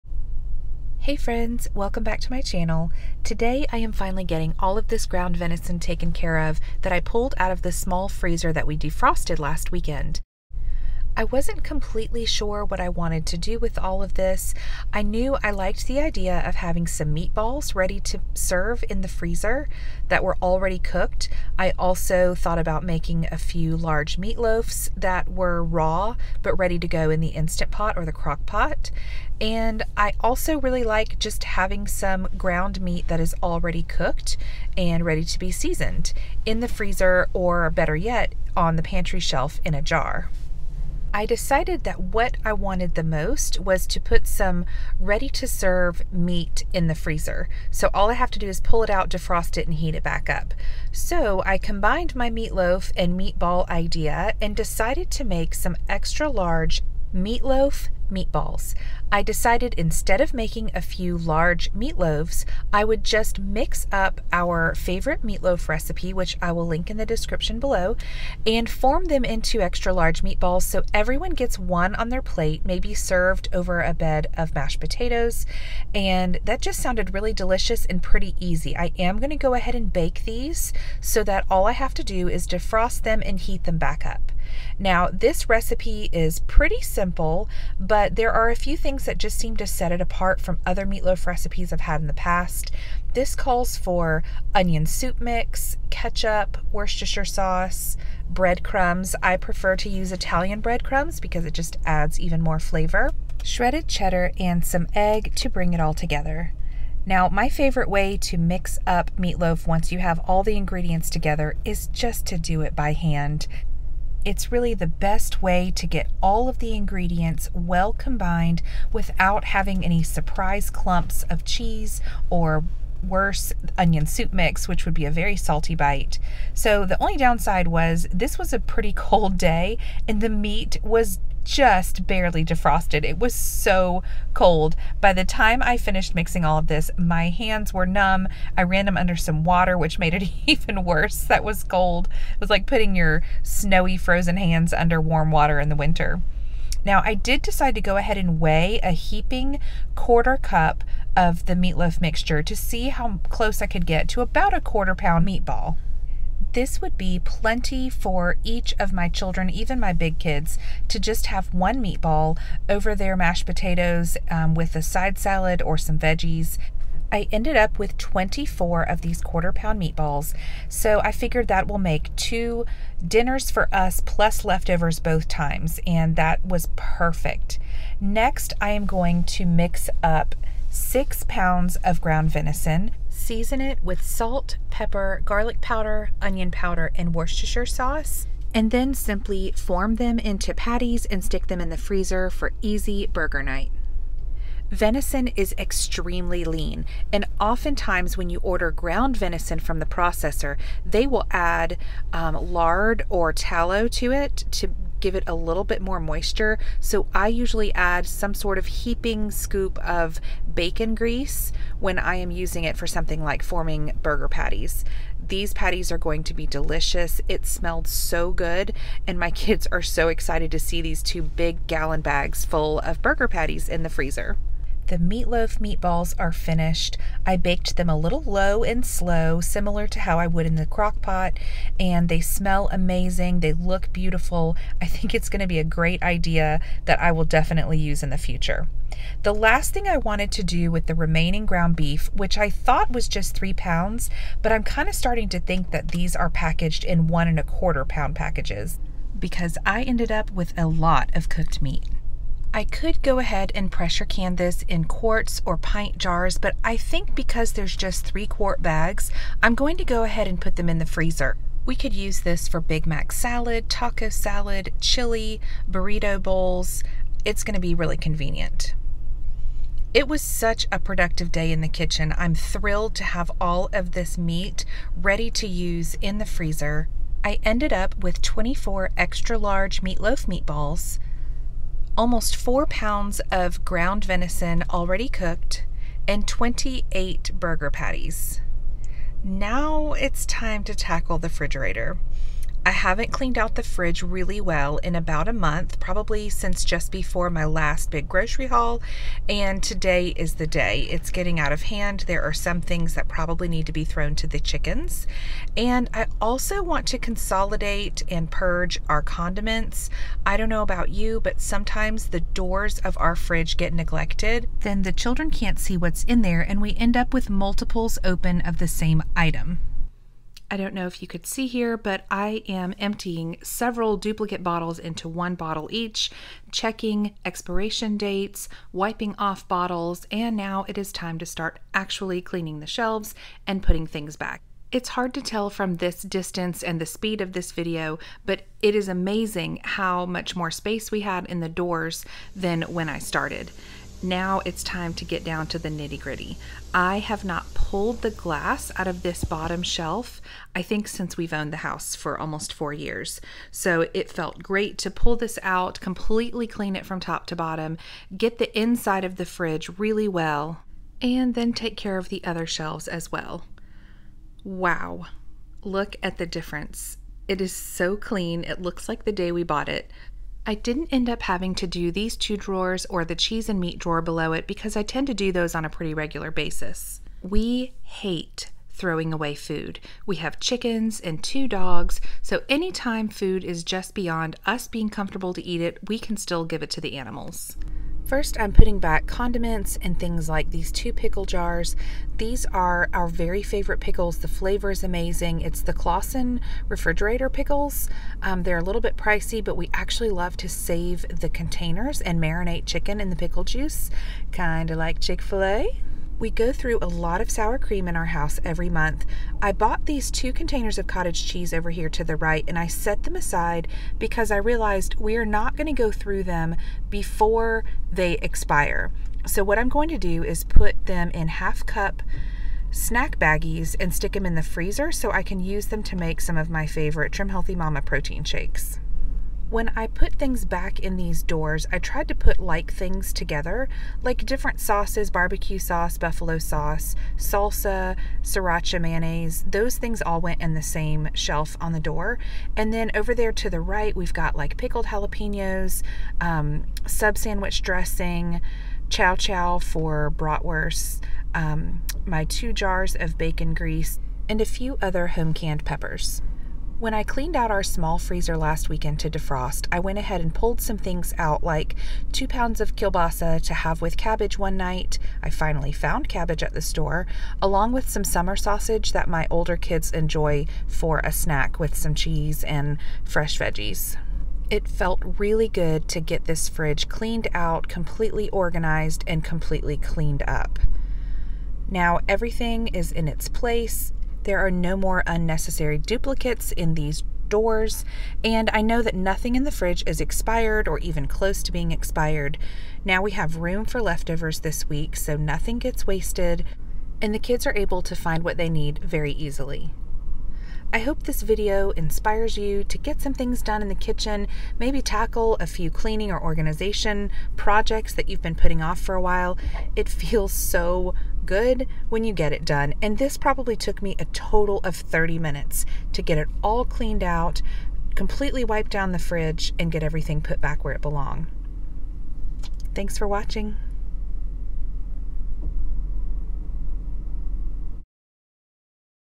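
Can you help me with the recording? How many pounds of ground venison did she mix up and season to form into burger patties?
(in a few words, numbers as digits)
6 pounds.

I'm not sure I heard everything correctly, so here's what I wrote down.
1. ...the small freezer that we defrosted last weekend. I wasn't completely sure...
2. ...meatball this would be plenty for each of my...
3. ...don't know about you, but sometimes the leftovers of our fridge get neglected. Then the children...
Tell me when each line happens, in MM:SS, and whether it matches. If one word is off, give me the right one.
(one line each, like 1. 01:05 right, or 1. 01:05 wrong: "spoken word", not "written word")
1. 00:07 right
2. 02:35 right
3. 05:10 wrong: "doors", not "leftovers".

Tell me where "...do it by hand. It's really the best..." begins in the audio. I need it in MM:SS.
01:52.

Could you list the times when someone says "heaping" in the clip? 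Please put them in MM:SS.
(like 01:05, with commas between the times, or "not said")
02:28, 03:28.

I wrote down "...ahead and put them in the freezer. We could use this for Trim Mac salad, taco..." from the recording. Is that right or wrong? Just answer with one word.
wrong.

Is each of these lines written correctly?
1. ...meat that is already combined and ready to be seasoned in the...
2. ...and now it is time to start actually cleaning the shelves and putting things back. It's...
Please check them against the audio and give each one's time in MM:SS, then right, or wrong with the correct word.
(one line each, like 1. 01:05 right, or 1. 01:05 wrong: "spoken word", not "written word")
1. 00:32 wrong: "cooked", not "combined"
2. 05:30 right.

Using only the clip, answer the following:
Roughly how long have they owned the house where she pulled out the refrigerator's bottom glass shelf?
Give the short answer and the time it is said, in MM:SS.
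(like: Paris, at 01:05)
almost 4 years, at 05:52.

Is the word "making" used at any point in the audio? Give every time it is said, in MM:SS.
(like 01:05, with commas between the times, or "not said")
00:22, 01:00.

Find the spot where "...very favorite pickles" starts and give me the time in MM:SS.
06:33.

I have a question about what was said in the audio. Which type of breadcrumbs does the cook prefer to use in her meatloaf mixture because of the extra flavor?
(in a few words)
Italian breadcrumbs.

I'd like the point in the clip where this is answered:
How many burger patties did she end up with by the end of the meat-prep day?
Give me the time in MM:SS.
04:46.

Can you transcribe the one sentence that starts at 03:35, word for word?
These patties are going to be delicious.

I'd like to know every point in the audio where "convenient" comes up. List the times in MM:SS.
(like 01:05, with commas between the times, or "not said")
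04:27.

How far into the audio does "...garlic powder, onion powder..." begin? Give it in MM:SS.
03:05.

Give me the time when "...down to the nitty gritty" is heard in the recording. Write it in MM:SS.
05:45.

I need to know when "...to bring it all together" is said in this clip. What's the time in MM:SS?
01:45.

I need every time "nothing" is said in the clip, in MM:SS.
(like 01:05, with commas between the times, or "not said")
08:08, 08:15.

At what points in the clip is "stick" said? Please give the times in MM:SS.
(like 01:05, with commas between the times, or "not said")
03:11, 07:03.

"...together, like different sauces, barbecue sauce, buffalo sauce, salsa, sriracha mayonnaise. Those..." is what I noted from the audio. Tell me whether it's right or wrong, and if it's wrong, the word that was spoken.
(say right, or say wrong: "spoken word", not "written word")
right.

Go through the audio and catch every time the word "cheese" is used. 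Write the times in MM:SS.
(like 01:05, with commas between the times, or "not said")
02:01, 06:13, 06:51, 07:51.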